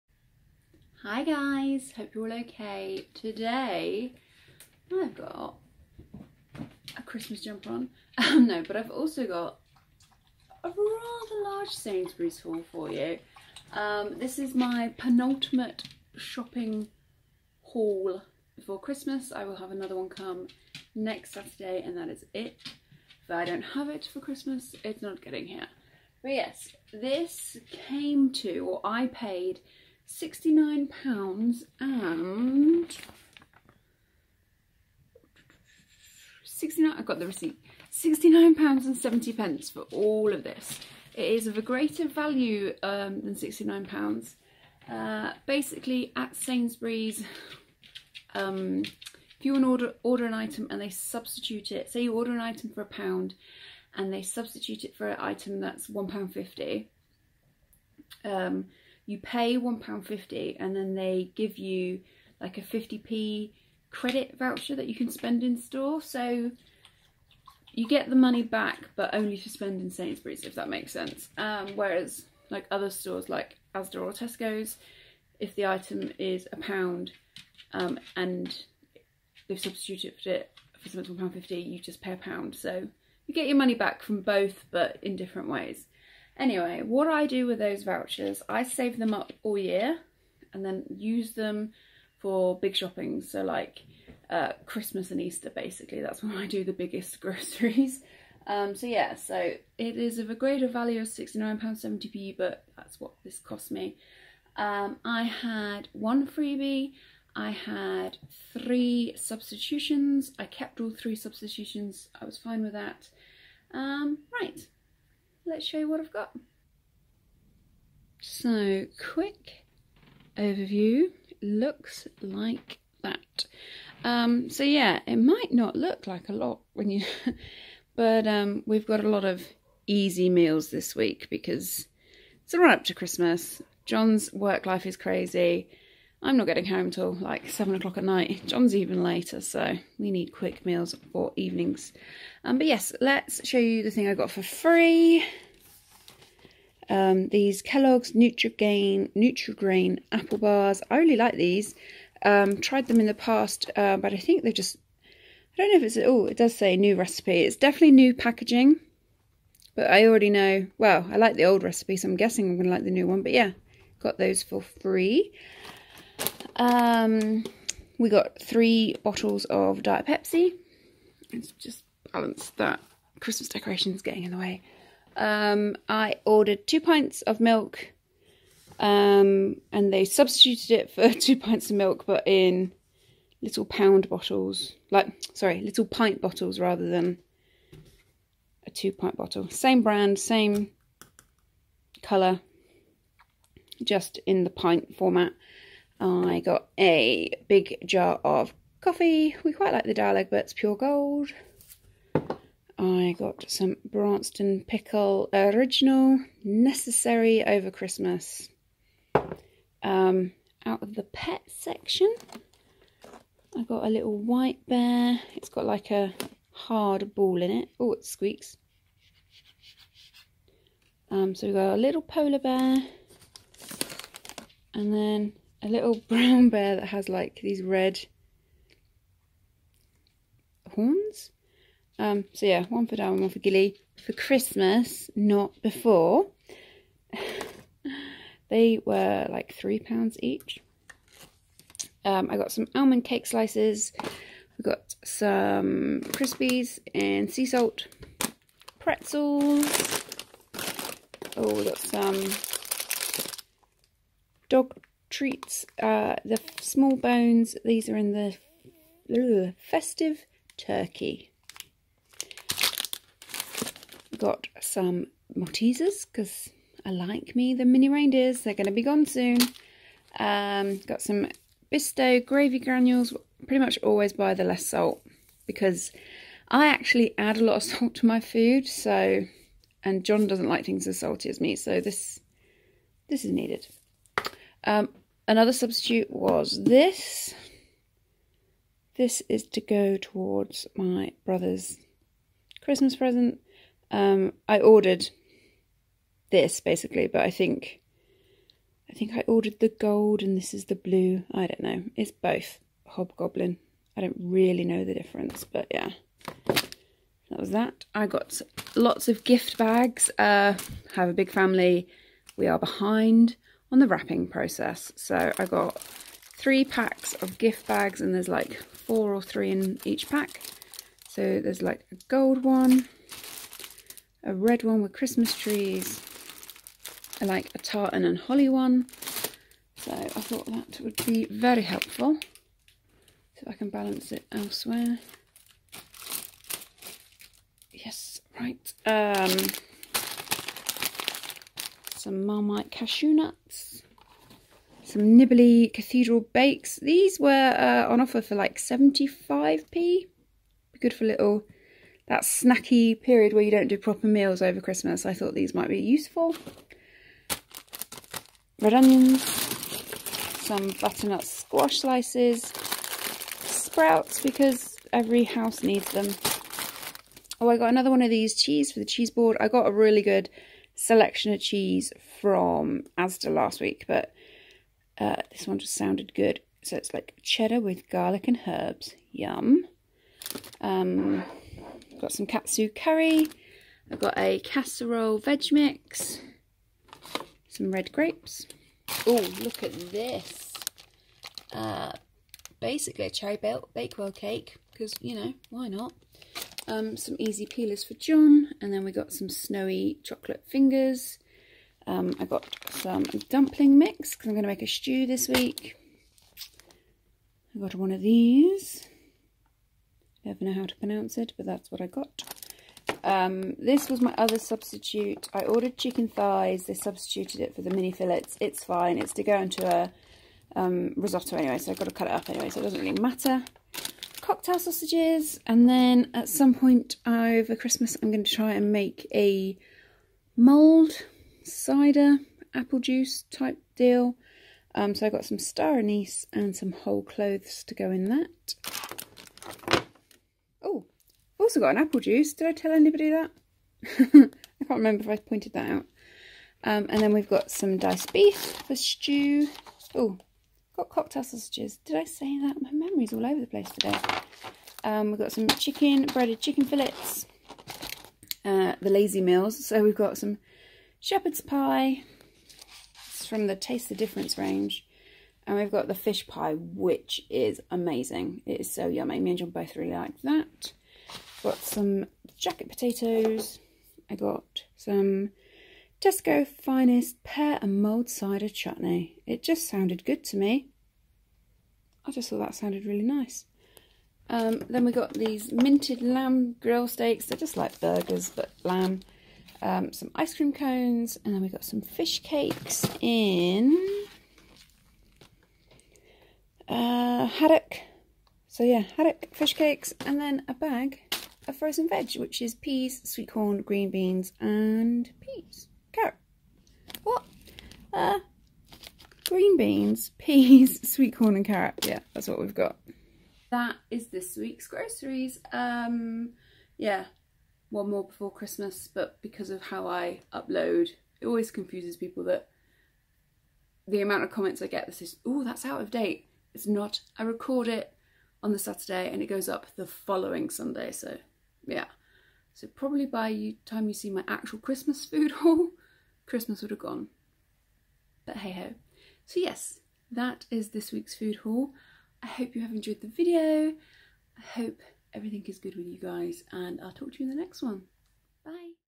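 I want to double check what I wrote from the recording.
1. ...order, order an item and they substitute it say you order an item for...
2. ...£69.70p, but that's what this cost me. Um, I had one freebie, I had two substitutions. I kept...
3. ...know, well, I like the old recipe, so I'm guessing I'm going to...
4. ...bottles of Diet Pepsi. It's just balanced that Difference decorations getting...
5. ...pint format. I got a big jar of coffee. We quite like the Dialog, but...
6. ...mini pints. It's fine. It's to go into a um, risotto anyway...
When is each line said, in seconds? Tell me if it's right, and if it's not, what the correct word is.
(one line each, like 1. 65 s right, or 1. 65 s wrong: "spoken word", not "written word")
1. 49 s right
2. 101 s wrong: "three", not "two"
3. 160 s right
4. 169 s wrong: "Christmas", not "Difference"
5. 194 s right
6. 417 s wrong: "fillets", not "pints".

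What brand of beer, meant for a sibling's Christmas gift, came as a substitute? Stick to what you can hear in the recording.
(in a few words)
Hobgoblin.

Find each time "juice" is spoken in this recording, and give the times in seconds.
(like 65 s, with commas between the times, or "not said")
432 s, 441 s.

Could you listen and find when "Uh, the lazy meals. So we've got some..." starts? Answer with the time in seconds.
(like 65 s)
458 s.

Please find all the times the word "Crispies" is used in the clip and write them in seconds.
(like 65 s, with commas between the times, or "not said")
246 s.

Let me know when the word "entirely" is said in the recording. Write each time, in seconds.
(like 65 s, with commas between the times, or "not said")
not said.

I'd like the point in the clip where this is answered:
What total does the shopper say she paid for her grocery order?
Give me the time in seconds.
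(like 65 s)
37 s.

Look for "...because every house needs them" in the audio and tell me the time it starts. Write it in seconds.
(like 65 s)
364 s.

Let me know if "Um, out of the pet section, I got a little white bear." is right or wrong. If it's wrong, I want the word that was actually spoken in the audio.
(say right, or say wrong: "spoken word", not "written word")
right.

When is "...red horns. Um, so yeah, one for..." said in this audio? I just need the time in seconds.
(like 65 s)
227 s.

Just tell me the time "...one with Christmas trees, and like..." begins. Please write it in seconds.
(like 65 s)
324 s.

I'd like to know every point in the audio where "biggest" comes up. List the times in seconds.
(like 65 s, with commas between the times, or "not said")
96 s.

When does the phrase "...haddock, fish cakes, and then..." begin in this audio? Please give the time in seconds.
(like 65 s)
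498 s.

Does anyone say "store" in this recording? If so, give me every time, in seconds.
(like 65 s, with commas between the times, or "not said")
65 s, 72 s.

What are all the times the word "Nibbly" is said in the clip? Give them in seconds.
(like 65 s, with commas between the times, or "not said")
345 s.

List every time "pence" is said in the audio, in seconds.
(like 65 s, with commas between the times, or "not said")
39 s.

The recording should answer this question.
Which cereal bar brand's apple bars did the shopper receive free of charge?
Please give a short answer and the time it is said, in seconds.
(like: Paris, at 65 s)
Kellogg's Nutrigrain, at 147 s.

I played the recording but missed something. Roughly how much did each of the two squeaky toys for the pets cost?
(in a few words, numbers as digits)
£3.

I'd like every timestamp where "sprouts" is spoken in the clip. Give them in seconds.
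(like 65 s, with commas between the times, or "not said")
363 s.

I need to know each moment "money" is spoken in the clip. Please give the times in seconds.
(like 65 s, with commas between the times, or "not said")
68 s, 83 s.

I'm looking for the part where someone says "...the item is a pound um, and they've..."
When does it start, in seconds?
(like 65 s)
75 s.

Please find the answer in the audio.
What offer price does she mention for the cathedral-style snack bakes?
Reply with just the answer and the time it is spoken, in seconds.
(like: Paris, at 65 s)
75p, at 348 s.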